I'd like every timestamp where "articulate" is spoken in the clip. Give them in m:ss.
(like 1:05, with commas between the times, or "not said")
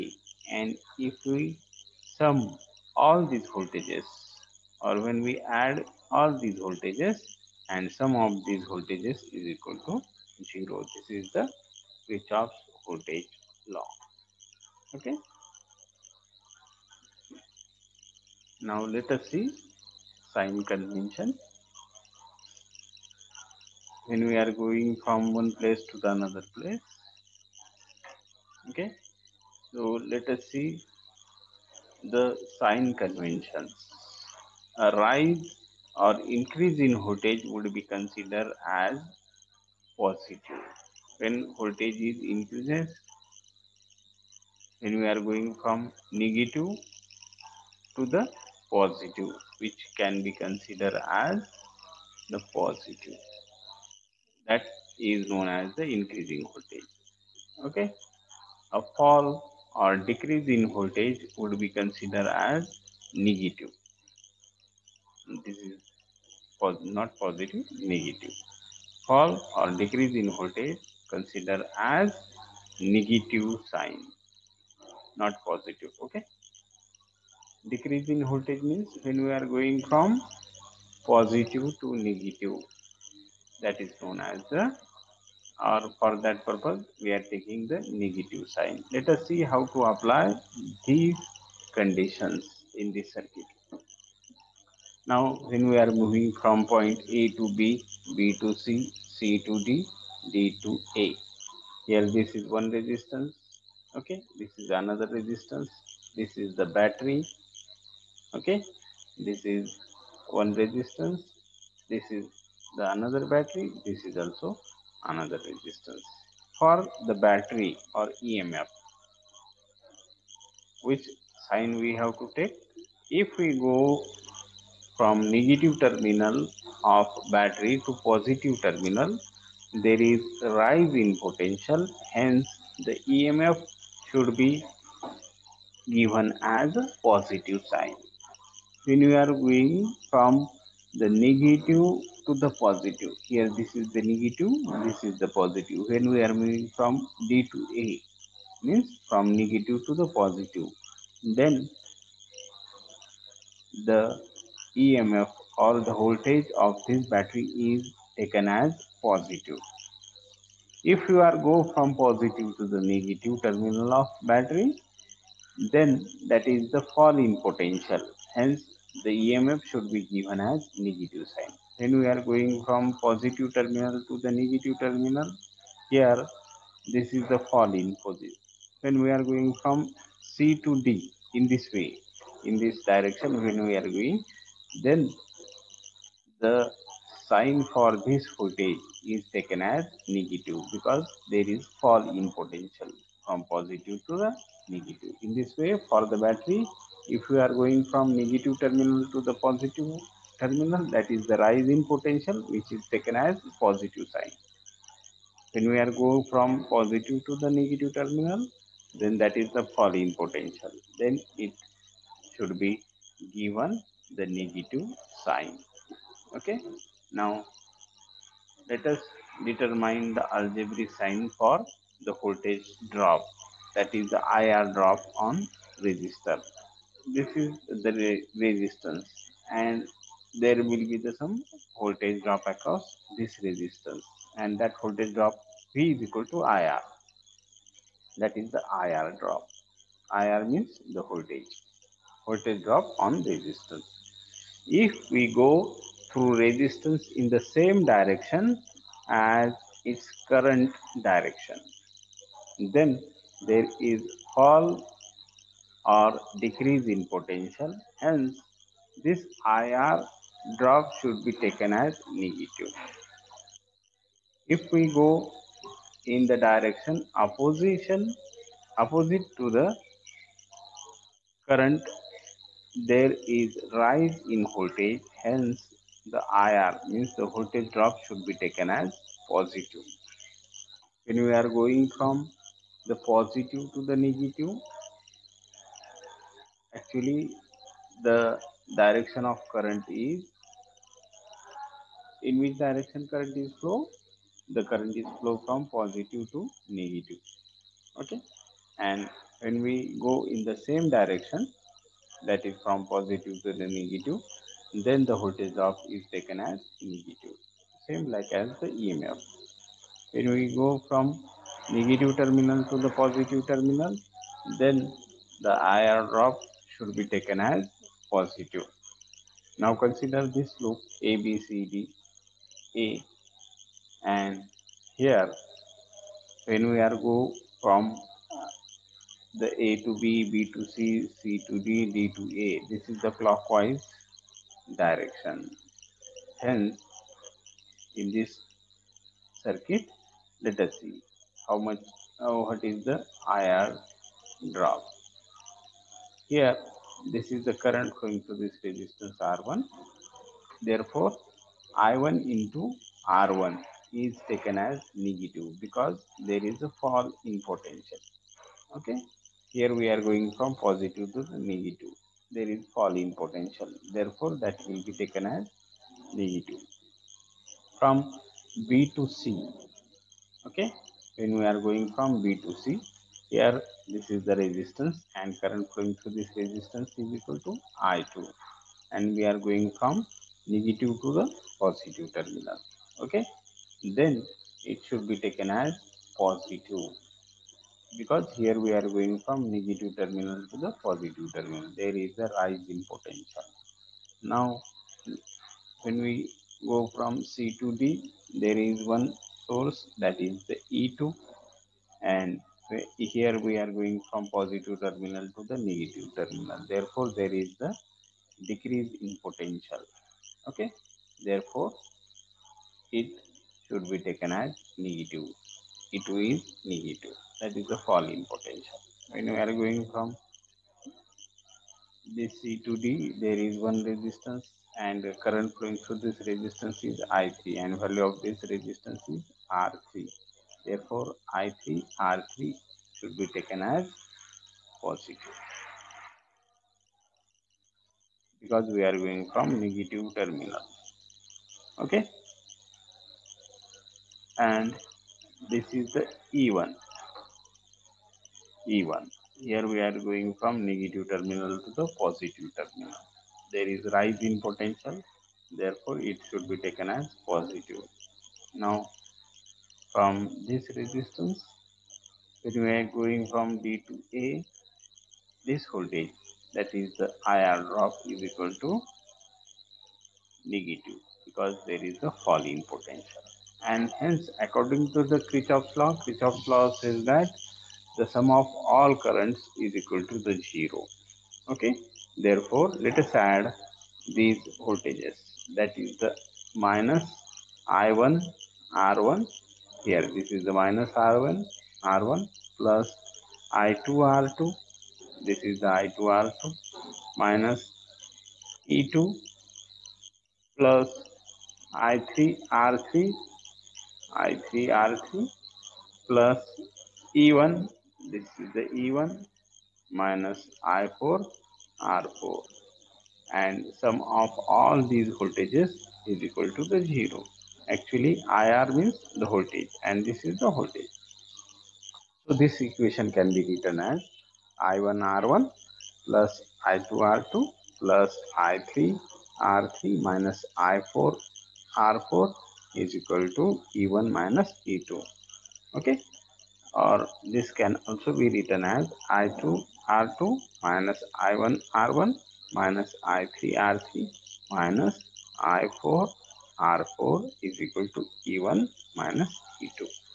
not said.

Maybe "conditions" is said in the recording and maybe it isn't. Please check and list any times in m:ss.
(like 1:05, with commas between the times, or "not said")
1:31.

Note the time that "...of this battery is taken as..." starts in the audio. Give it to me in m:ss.
2:36.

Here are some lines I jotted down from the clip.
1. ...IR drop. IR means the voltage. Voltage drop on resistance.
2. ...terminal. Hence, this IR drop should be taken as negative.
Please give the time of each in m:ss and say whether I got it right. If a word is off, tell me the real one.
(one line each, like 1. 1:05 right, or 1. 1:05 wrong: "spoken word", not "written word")
1. 3:58 right
2. 4:17 wrong: "potential", not "terminal".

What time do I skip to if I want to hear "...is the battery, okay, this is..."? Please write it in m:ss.
1:46.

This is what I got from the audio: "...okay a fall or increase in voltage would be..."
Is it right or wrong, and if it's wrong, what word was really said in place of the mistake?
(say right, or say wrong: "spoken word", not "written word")
wrong: "decrease", not "increase".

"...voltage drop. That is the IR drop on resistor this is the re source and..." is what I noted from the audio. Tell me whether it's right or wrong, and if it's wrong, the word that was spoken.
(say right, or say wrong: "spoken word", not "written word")
wrong: "resistance", not "source".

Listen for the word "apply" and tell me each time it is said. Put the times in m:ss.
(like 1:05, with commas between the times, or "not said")
1:29.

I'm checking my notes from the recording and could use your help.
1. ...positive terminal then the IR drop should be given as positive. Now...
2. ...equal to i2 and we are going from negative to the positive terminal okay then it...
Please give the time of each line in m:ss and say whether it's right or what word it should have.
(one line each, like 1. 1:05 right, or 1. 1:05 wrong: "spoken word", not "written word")
1. 5:13 wrong: "taken", not "given"
2. 6:17 right.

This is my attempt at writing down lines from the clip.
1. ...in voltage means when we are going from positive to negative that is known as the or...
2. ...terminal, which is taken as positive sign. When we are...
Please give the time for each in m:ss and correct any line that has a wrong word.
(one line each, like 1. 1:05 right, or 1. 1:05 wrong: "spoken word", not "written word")
1. 1:18 right
2. 3:21 wrong: "potential", not "terminal".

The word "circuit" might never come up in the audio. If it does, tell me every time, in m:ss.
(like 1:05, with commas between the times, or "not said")
1:33, 5:39.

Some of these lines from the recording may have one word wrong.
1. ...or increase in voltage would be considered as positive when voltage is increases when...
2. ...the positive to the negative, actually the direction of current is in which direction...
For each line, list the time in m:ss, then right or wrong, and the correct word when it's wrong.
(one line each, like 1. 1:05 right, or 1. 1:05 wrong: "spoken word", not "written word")
1. 0:36 right
2. 4:42 right.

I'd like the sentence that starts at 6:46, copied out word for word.
Therefore, there is the decrease in potential.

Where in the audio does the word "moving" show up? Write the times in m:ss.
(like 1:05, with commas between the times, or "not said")
1:36, 2:26.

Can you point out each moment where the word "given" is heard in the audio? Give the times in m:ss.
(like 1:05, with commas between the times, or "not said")
2:15, 2:50, 3:33.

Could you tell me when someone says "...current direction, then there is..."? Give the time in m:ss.
4:10.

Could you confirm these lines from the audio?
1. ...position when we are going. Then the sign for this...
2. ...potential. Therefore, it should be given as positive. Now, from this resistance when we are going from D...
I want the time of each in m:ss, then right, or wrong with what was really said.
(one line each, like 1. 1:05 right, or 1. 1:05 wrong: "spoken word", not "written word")
1. 3:02 wrong: "direction", not "position"
2. 7:34 wrong: "taken", not "given".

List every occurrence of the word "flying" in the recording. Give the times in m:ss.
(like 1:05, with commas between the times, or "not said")
not said.